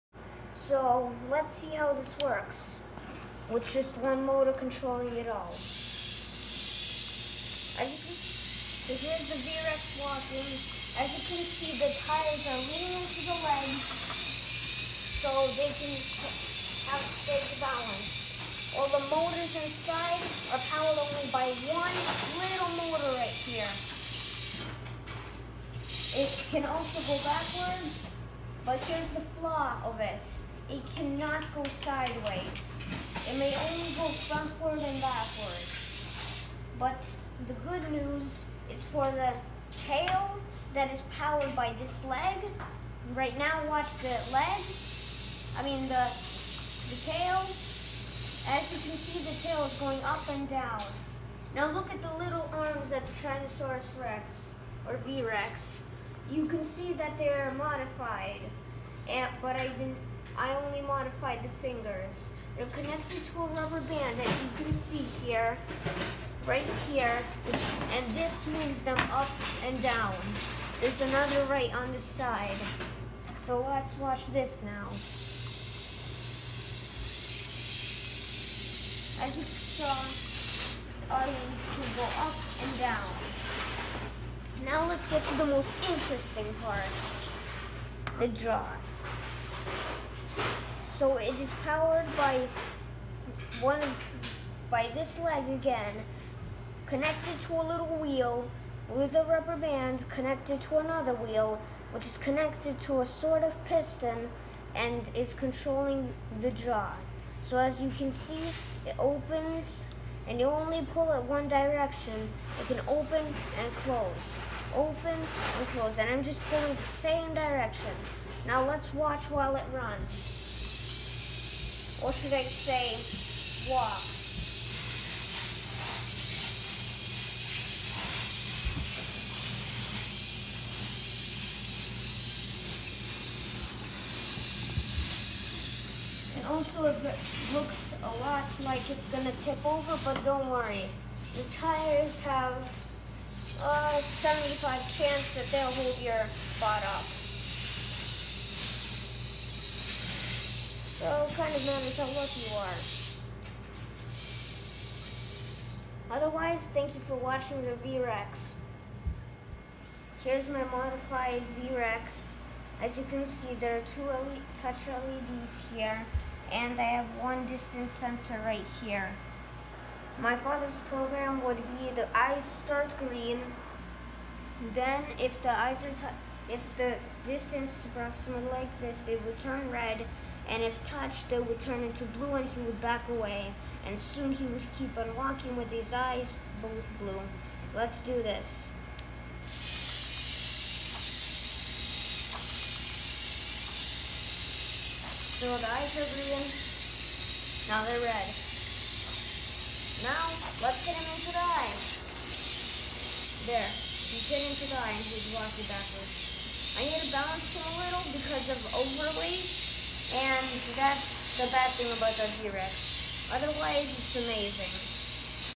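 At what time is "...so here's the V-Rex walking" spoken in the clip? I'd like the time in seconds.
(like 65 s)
8 s.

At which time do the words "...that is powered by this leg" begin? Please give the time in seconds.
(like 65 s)
40 s.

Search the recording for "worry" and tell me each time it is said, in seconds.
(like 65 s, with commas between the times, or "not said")
140 s.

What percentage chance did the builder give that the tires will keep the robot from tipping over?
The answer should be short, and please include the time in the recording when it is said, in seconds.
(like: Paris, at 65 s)
75, at 144 s.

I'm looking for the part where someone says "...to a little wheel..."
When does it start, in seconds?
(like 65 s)
97 s.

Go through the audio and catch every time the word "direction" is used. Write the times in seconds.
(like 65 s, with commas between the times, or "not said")
111 s, 117 s.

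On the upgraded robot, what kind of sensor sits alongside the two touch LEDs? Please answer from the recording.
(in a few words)
distance sensor.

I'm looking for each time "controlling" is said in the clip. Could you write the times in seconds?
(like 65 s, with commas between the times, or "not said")
4 s, 105 s.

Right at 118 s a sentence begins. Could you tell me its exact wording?
Now let's watch while it runs.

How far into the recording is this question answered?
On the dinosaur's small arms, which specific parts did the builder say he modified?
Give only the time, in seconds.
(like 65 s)
61 s.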